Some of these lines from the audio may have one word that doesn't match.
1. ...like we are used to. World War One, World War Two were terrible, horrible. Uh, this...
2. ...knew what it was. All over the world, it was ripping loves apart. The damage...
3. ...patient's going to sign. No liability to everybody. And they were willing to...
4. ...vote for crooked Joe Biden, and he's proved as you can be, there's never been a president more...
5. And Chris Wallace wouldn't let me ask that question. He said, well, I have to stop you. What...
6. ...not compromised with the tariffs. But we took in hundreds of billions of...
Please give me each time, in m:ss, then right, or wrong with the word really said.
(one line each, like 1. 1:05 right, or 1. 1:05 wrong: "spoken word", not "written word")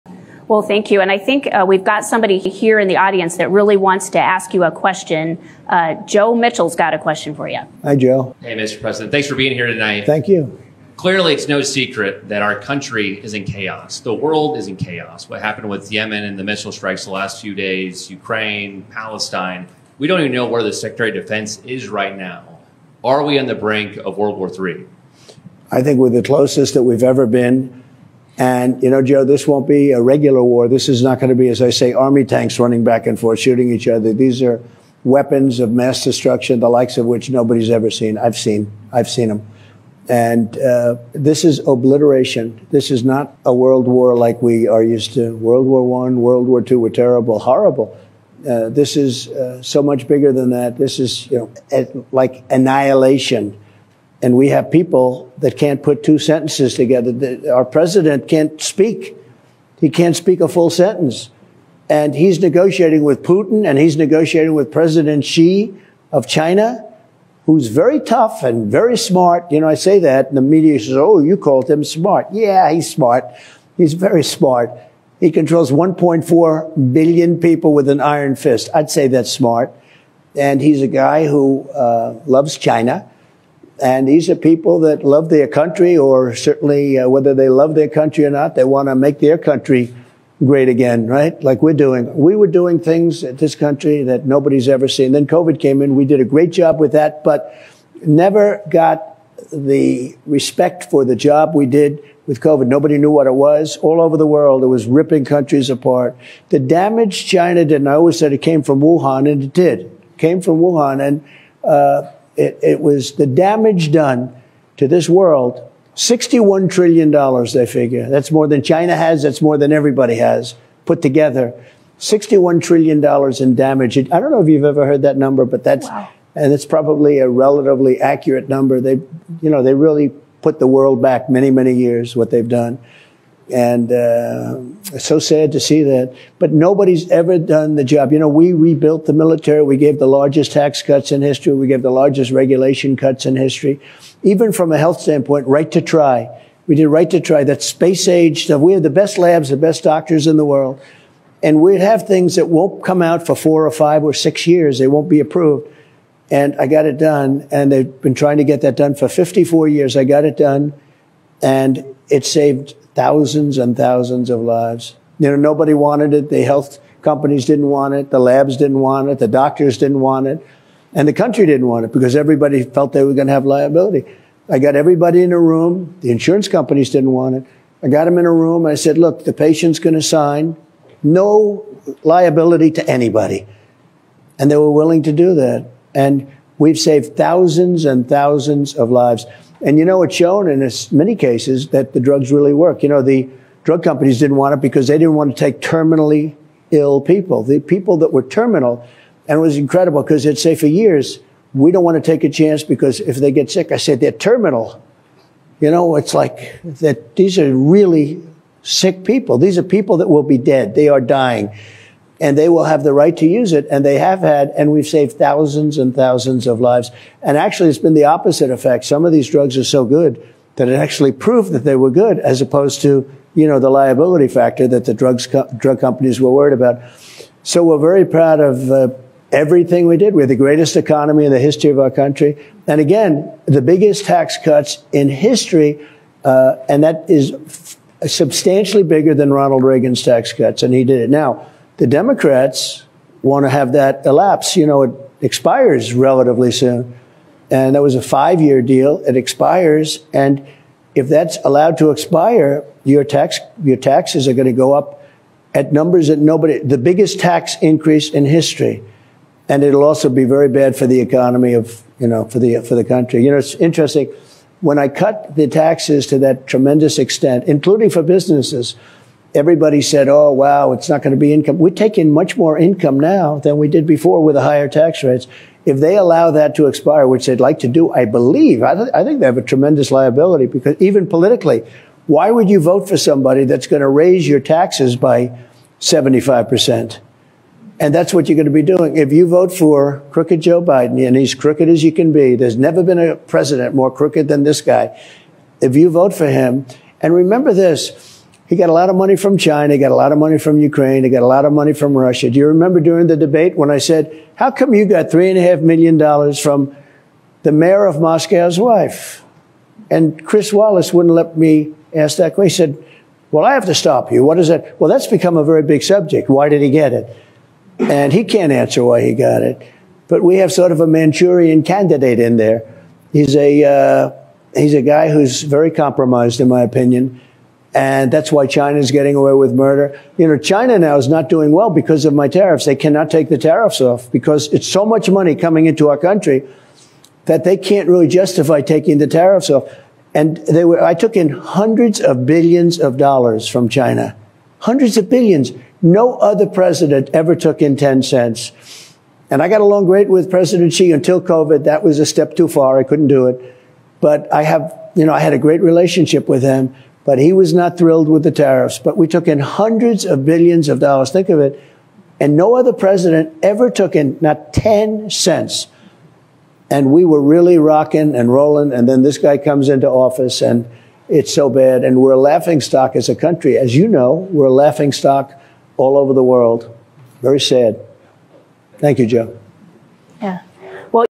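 1. 0:44 right
2. 1:42 wrong: "countries", not "loves"
3. 2:59 wrong: "anybody", not "everybody"
4. 4:49 wrong: "crooked", not "proved"
5. 5:09 right
6. 5:57 wrong: "thrilled", not "compromised".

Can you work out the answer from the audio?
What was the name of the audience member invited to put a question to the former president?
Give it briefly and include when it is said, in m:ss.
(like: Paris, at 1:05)
Joe Mitchell, at 0:06.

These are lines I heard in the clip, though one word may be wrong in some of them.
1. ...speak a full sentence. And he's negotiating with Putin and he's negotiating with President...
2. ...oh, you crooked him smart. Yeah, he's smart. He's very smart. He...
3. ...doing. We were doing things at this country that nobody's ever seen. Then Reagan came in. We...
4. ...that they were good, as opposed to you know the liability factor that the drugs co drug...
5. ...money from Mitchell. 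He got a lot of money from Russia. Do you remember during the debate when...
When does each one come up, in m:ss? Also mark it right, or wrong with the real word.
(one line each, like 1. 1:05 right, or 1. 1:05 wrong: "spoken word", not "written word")
1. 1:00 right
2. 1:10 wrong: "called", not "crooked"
3. 1:31 wrong: "COVID", not "Reagan"
4. 3:41 right
5. 5:00 wrong: "Ukraine", not "Mitchell".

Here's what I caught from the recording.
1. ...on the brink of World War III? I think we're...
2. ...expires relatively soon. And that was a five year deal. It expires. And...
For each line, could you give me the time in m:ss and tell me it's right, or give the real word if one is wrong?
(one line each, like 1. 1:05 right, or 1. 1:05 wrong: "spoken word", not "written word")
1. 0:23 right
2. 4:05 right.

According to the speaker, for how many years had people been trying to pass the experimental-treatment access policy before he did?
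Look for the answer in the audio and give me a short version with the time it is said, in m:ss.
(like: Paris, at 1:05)
54, at 2:39.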